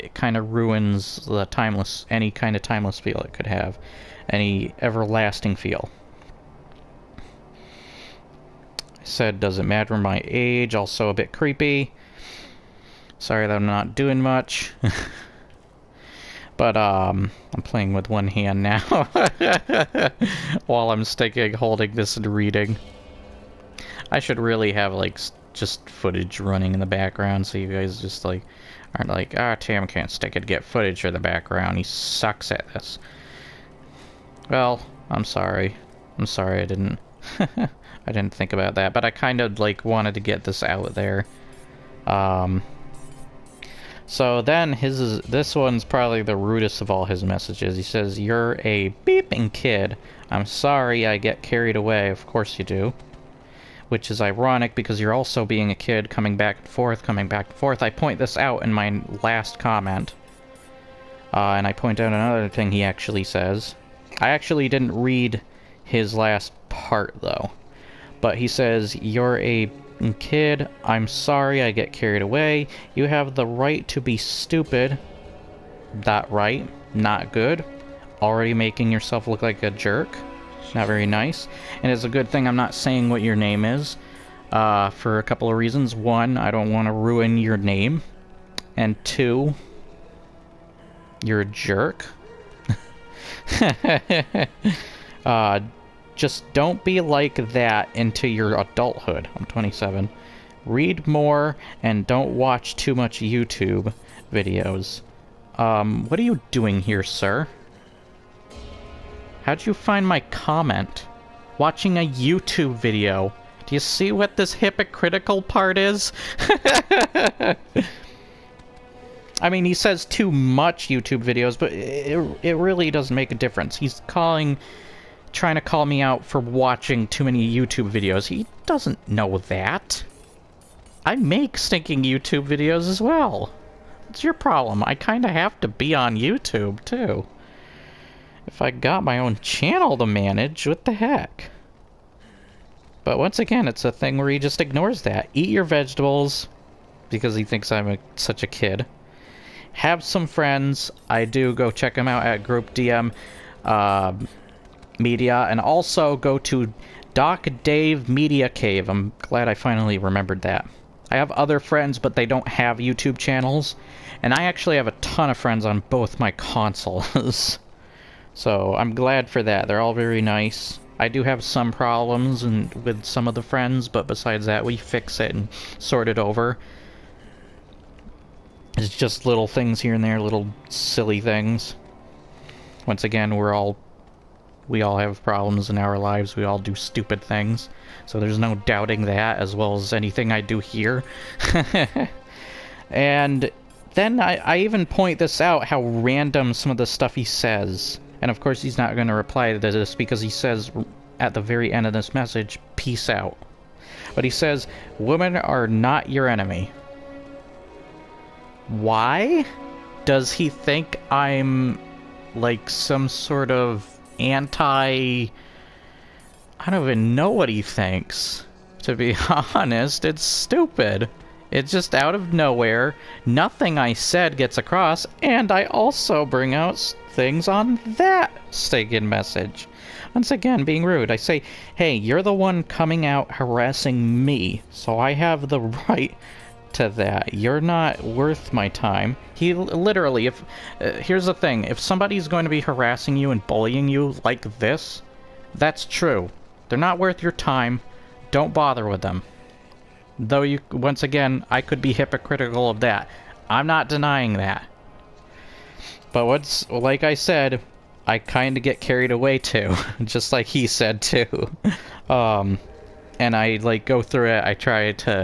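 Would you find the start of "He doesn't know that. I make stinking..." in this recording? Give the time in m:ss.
2:08.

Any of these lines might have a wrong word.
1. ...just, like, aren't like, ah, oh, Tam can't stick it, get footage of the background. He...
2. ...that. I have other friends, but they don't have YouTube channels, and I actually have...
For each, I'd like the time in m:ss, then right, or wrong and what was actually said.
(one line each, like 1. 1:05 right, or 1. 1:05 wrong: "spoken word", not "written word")
1. 0:28 right
2. 2:40 right.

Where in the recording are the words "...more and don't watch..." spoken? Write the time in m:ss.
1:41.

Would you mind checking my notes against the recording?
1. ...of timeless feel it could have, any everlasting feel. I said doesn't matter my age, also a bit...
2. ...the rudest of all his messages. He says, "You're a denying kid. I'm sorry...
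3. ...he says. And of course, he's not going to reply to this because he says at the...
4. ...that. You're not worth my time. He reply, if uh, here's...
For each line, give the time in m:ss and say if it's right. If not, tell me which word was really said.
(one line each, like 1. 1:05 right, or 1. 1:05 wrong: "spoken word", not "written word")
1. 0:02 right
2. 0:46 wrong: "beeping", not "denying"
3. 3:17 right
4. 3:56 wrong: "literally", not "reply".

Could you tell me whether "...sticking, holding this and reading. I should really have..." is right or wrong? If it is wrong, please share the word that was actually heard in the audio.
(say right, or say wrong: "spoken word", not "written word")
right.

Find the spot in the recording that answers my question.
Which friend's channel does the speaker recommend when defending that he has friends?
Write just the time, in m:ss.
2:37.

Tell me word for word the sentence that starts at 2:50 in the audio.
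I do have some problems and with some of the friends, but besides that, we fix it and sort it over.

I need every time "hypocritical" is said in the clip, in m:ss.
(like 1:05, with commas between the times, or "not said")
1:54, 4:11.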